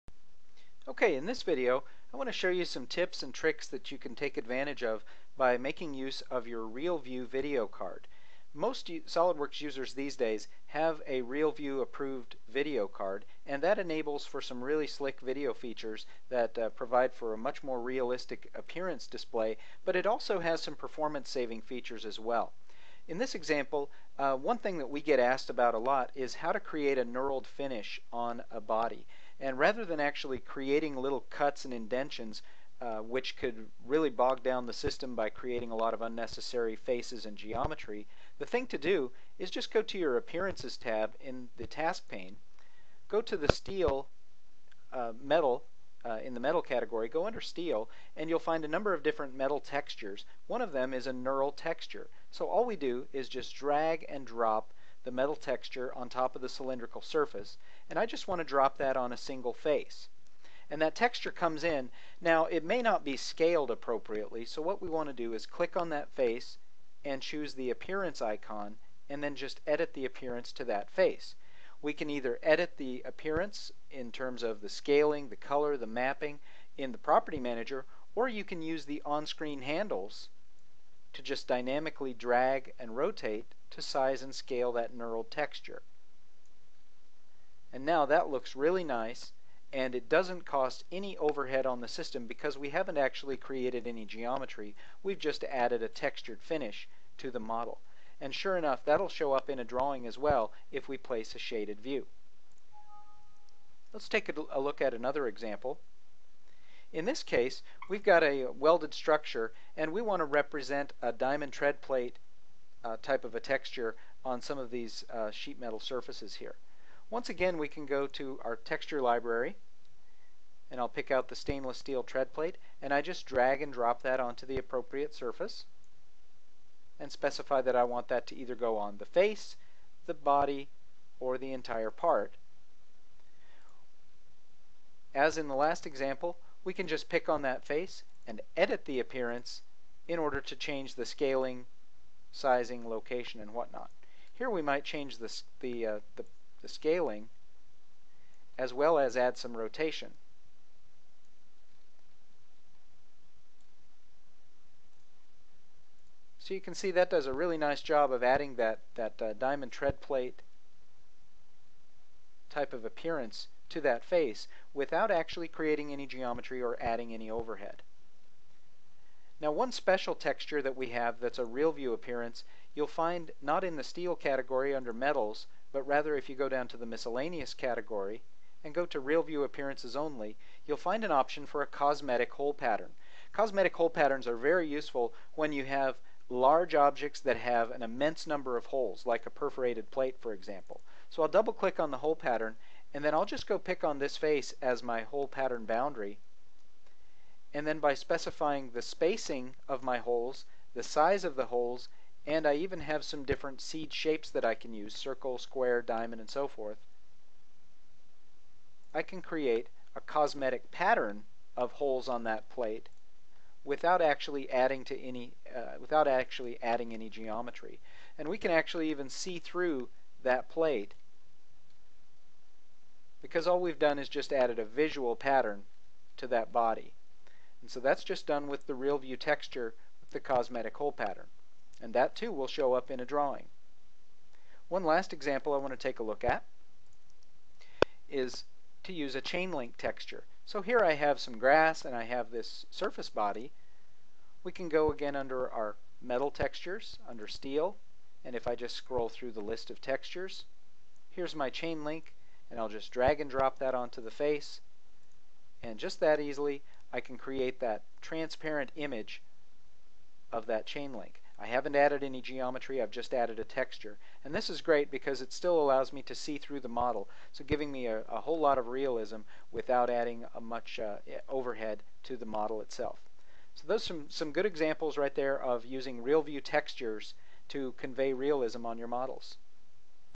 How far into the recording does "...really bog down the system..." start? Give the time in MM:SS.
00:33.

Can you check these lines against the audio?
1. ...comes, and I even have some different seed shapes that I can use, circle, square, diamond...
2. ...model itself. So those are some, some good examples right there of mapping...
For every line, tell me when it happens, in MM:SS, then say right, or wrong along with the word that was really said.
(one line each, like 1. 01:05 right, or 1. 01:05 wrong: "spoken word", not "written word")
1. 03:21 wrong: "holes", not "comes"
2. 04:32 wrong: "using", not "mapping".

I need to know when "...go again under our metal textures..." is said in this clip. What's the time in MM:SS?
04:04.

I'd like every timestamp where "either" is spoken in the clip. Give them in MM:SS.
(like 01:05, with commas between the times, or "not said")
01:12, 02:08.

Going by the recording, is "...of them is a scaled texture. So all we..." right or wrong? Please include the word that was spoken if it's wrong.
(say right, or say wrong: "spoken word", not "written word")
wrong: "knurled", not "scaled".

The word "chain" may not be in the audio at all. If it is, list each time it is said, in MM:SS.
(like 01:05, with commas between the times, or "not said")
03:59, 04:11, 04:20.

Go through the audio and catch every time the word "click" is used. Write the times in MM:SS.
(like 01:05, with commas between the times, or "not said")
01:05, 03:11.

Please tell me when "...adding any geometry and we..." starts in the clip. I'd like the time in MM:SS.
03:36.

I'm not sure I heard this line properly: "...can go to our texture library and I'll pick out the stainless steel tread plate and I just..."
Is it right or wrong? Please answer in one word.
right.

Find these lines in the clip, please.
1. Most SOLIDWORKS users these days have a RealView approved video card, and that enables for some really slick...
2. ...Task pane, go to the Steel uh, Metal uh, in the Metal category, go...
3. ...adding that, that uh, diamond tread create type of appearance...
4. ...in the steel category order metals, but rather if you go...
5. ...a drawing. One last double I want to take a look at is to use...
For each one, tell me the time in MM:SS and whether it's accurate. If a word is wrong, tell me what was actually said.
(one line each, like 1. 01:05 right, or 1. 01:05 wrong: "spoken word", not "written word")
1. 00:08 right
2. 00:41 right
3. 02:38 wrong: "plate", not "create"
4. 02:53 wrong: "under", not "order"
5. 03:52 wrong: "example", not "double".